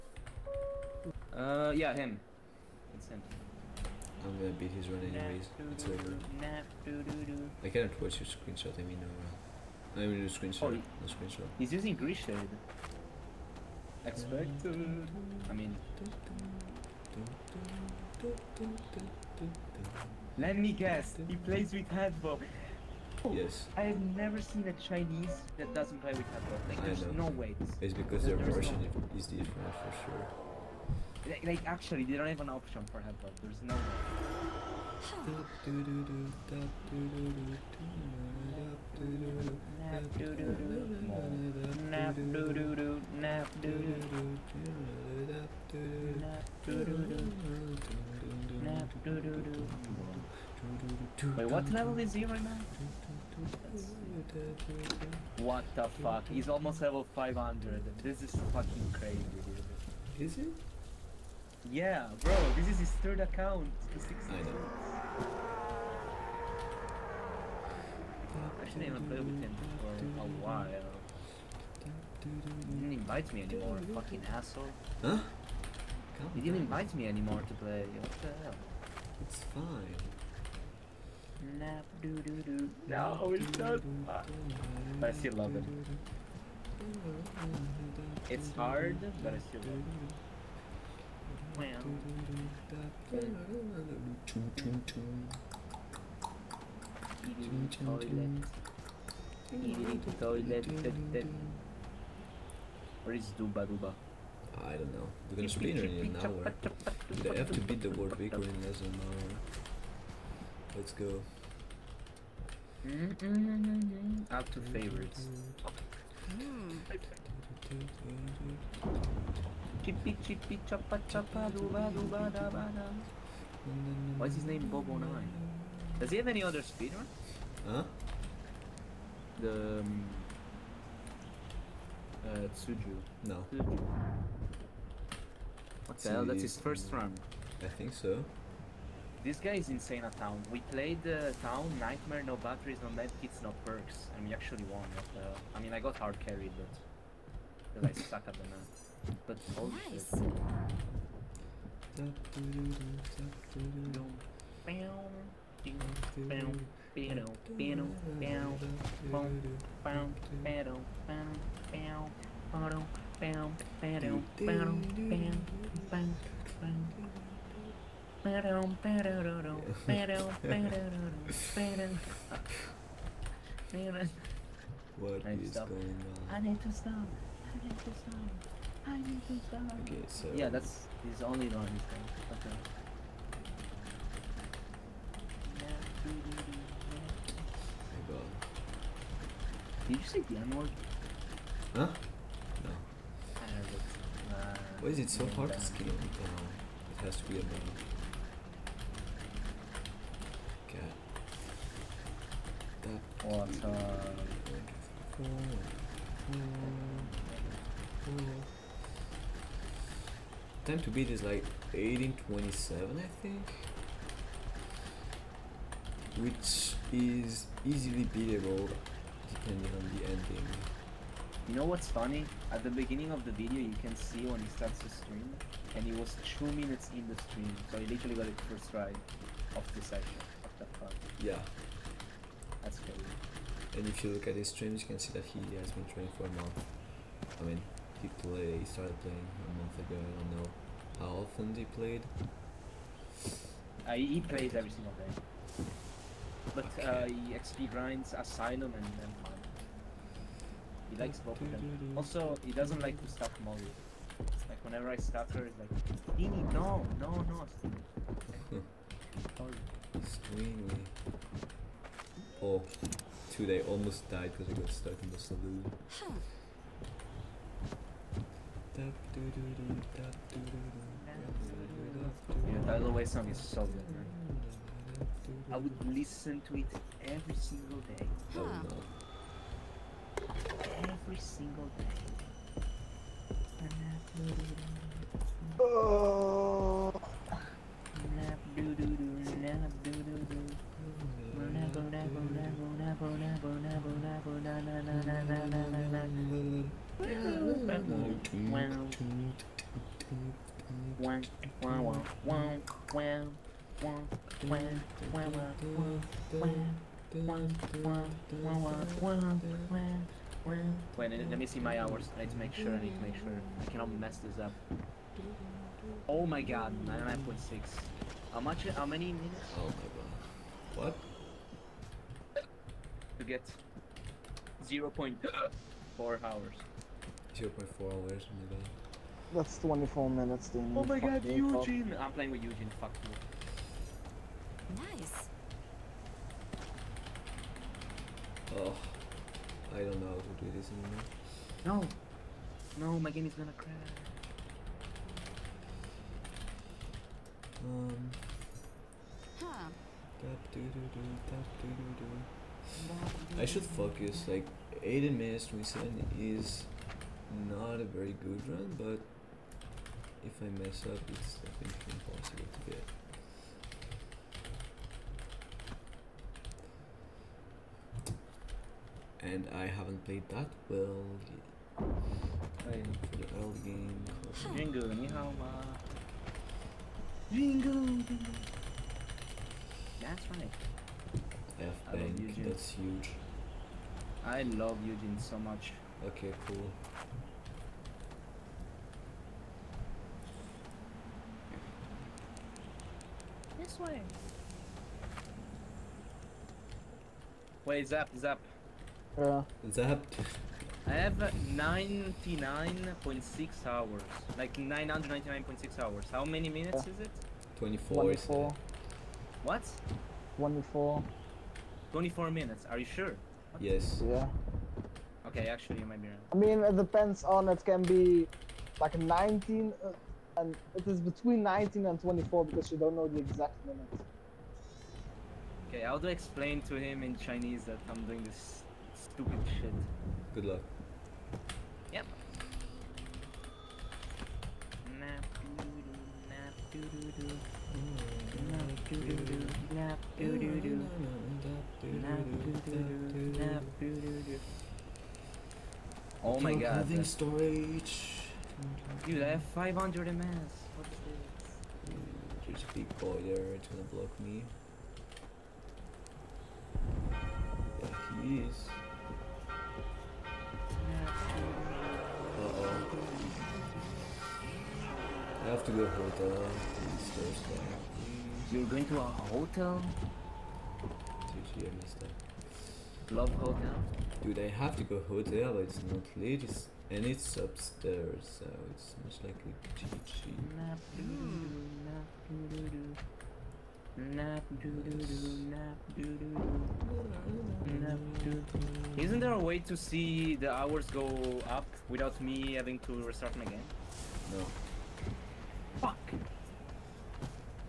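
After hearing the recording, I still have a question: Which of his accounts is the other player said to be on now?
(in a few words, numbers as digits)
third.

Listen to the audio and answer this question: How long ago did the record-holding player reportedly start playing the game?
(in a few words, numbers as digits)
a month ago.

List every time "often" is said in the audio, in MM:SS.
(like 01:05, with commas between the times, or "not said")
04:01.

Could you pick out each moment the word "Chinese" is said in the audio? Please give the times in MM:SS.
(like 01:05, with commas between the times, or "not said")
00:24, 07:07.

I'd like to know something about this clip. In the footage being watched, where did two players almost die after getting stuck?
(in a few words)
the saloon.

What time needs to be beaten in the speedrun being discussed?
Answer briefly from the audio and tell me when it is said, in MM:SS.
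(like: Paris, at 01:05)
1827, at 03:31.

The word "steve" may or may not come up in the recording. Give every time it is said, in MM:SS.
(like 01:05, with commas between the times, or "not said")
not said.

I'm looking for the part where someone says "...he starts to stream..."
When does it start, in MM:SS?
03:44.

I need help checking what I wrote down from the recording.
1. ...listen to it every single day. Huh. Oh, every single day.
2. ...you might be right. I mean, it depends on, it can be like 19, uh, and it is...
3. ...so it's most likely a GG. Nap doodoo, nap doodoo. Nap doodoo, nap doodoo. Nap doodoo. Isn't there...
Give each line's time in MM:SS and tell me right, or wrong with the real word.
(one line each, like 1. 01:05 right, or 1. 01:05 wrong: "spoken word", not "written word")
1. 04:35 right
2. 06:55 right
3. 07:58 right.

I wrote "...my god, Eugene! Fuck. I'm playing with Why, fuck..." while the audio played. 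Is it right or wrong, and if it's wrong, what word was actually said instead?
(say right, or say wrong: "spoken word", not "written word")
wrong: "Eugene", not "Why".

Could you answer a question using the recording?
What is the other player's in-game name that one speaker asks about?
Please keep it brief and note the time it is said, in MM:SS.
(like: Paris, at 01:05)
Bobo Nine, at 02:04.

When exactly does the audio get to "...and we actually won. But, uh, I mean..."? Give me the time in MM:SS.
02:24.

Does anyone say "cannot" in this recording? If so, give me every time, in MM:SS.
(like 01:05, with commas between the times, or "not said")
00:07, 05:13.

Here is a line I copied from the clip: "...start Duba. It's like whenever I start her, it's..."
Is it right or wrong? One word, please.
wrong.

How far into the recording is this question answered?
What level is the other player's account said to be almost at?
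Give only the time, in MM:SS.
00:56.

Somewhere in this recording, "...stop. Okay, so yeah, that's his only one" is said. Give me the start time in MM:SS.
02:59.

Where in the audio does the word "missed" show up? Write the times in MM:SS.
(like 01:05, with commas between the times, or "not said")
07:51.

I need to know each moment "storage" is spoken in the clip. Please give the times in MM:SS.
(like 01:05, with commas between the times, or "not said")
07:27.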